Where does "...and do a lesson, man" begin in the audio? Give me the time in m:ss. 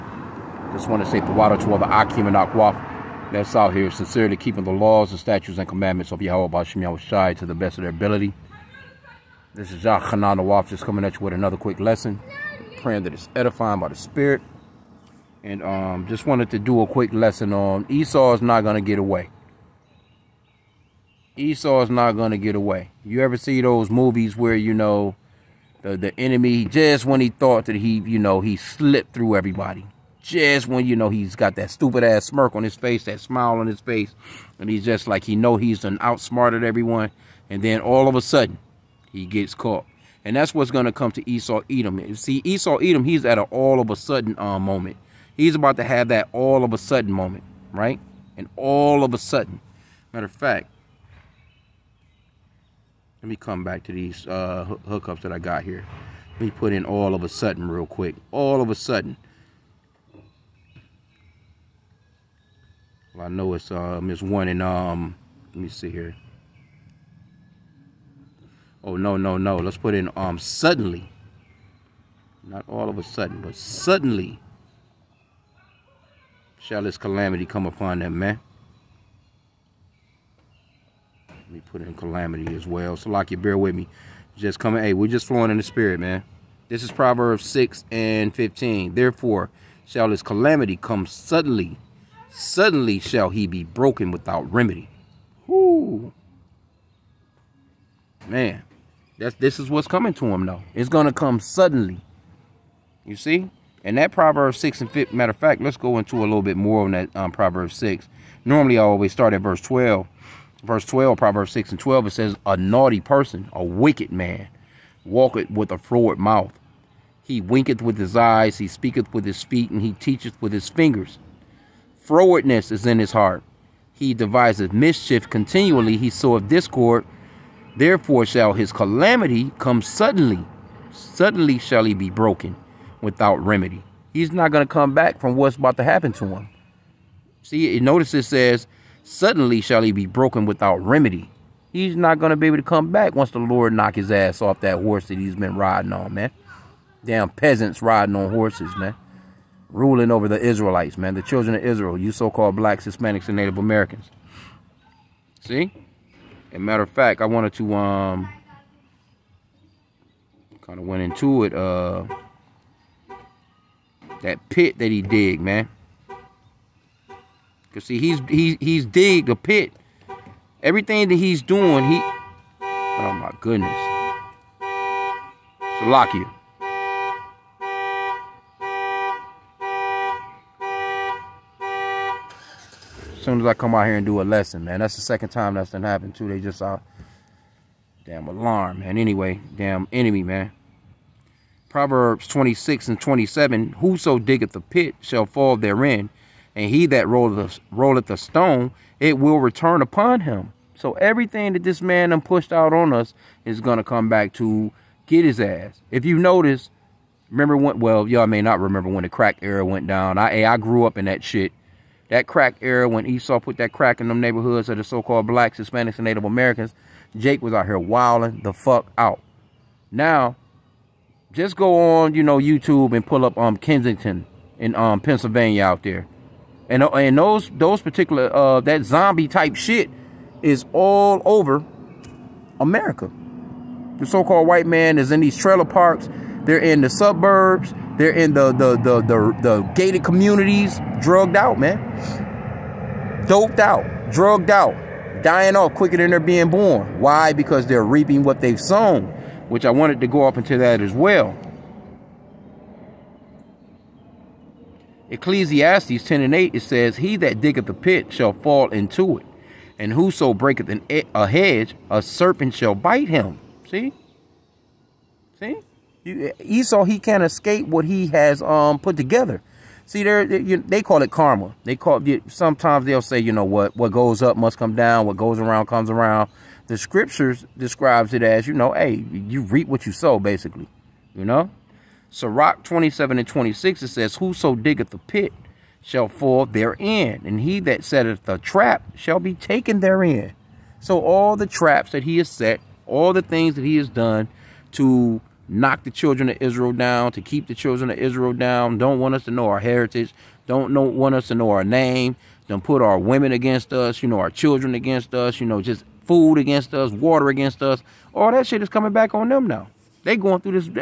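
3:03.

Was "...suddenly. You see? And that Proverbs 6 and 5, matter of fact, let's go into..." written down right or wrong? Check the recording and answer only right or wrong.
right.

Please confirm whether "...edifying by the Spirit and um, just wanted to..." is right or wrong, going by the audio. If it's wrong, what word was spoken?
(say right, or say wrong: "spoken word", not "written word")
right.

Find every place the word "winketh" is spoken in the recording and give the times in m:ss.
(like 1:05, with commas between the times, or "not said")
1:57.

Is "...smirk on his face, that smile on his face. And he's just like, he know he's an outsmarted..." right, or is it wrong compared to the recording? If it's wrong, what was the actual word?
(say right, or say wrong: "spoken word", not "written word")
right.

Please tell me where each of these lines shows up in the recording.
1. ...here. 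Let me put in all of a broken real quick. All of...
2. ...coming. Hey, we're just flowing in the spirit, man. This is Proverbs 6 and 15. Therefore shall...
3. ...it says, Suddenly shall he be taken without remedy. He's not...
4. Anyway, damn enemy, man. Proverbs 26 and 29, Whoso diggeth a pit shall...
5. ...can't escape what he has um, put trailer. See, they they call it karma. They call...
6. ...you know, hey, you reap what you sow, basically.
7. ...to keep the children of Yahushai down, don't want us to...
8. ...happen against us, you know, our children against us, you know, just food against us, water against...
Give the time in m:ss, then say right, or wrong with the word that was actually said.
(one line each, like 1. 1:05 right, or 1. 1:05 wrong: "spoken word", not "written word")
1. 0:55 wrong: "sudden", not "broken"
2. 1:24 right
3. 2:18 wrong: "broken", not "taken"
4. 3:08 wrong: "27", not "29"
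5. 4:26 wrong: "together", not "trailer"
6. 4:38 right
7. 4:57 wrong: "Israel", not "Yahushai"
8. 5:02 wrong: "women", not "happen".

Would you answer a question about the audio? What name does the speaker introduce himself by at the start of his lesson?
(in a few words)
Yah Hanan.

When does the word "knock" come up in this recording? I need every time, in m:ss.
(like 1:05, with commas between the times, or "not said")
2:23, 4:55.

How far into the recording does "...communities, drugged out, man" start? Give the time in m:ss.
4:00.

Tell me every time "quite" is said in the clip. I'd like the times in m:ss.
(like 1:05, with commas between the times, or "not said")
not said.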